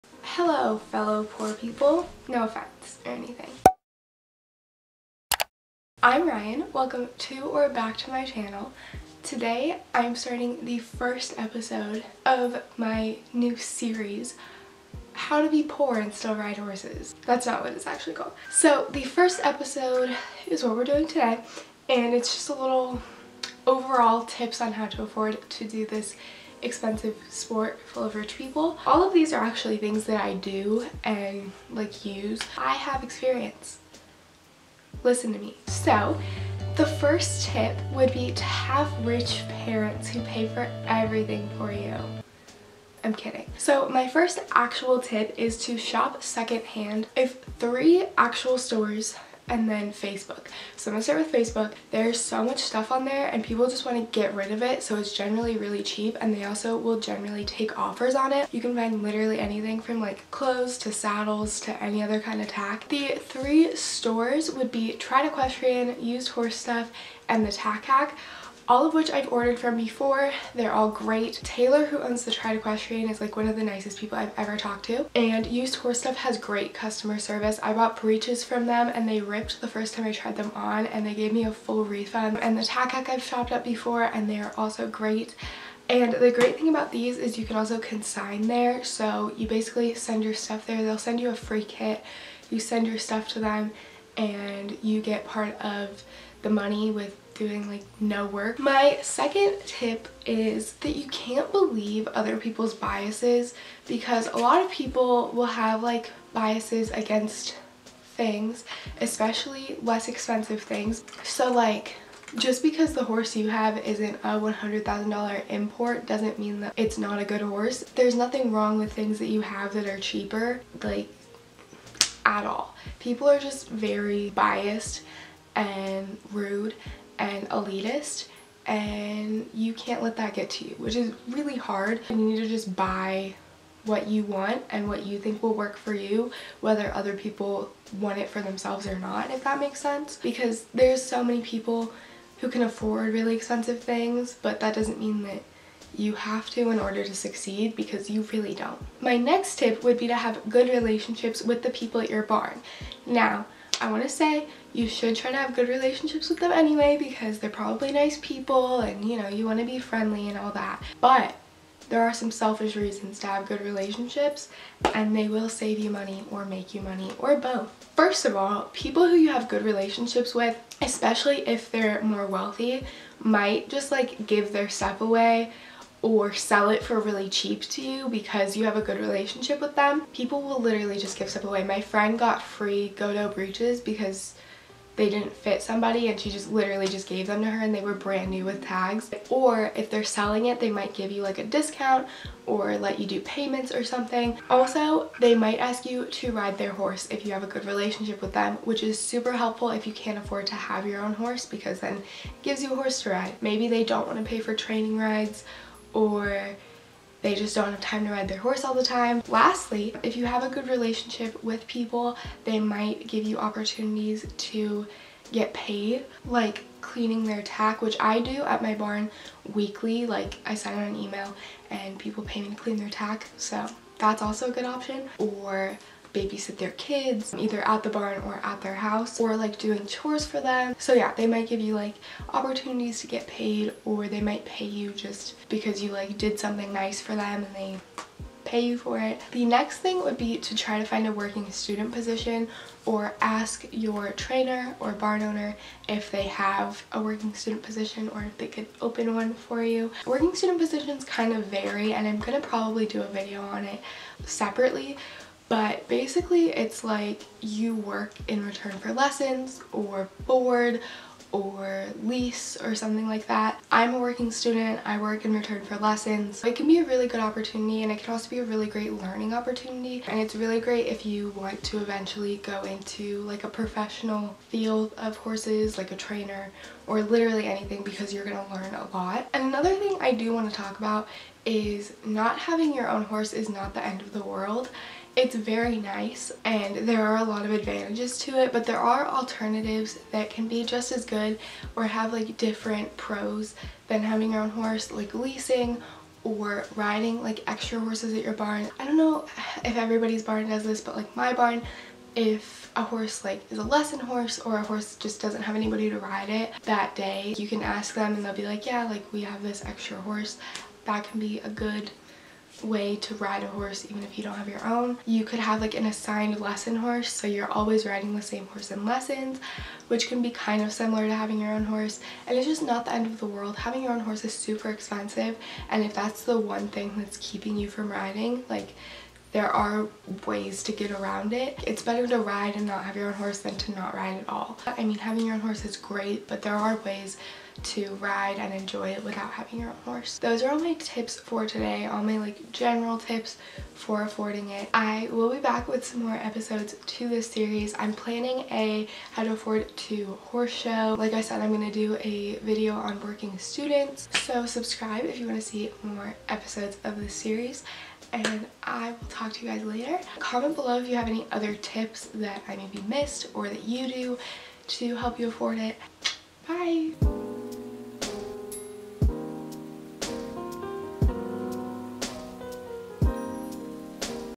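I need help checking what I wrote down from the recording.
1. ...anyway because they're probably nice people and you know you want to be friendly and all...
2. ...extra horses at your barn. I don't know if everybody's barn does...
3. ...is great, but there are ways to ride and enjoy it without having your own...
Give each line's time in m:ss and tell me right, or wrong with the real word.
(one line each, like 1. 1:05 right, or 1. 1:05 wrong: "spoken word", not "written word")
1. 2:36 right
2. 4:57 right
3. 5:35 right.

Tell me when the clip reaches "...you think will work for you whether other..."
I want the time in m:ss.
2:15.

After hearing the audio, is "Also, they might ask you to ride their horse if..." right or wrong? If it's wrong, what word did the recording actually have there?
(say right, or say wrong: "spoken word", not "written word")
right.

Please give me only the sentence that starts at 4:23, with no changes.
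I'm a working student, I work in return for lessons.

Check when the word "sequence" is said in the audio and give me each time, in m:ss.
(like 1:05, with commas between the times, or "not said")
not said.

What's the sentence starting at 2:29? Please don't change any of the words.
My next tip would be to have good relationships with the people at your barn.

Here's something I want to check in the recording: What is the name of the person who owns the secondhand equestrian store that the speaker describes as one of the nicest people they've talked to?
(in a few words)
Taylor.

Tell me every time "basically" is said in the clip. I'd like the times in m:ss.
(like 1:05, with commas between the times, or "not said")
1:29, 4:15.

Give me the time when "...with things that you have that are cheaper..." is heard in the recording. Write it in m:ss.
1:58.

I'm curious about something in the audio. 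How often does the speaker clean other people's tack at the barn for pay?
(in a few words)
Weekly.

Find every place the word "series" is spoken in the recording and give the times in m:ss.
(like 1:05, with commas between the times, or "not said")
0:13, 5:47, 5:57.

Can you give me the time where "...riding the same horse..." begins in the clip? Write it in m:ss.
5:17.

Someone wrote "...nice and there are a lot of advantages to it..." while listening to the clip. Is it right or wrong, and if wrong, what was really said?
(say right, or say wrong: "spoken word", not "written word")
right.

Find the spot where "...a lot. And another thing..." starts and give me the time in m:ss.
4:38.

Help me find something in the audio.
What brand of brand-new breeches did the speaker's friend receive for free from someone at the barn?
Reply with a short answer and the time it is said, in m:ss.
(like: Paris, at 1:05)
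Ghodho, at 3:02.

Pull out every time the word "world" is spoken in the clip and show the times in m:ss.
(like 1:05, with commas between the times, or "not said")
4:44, 5:23.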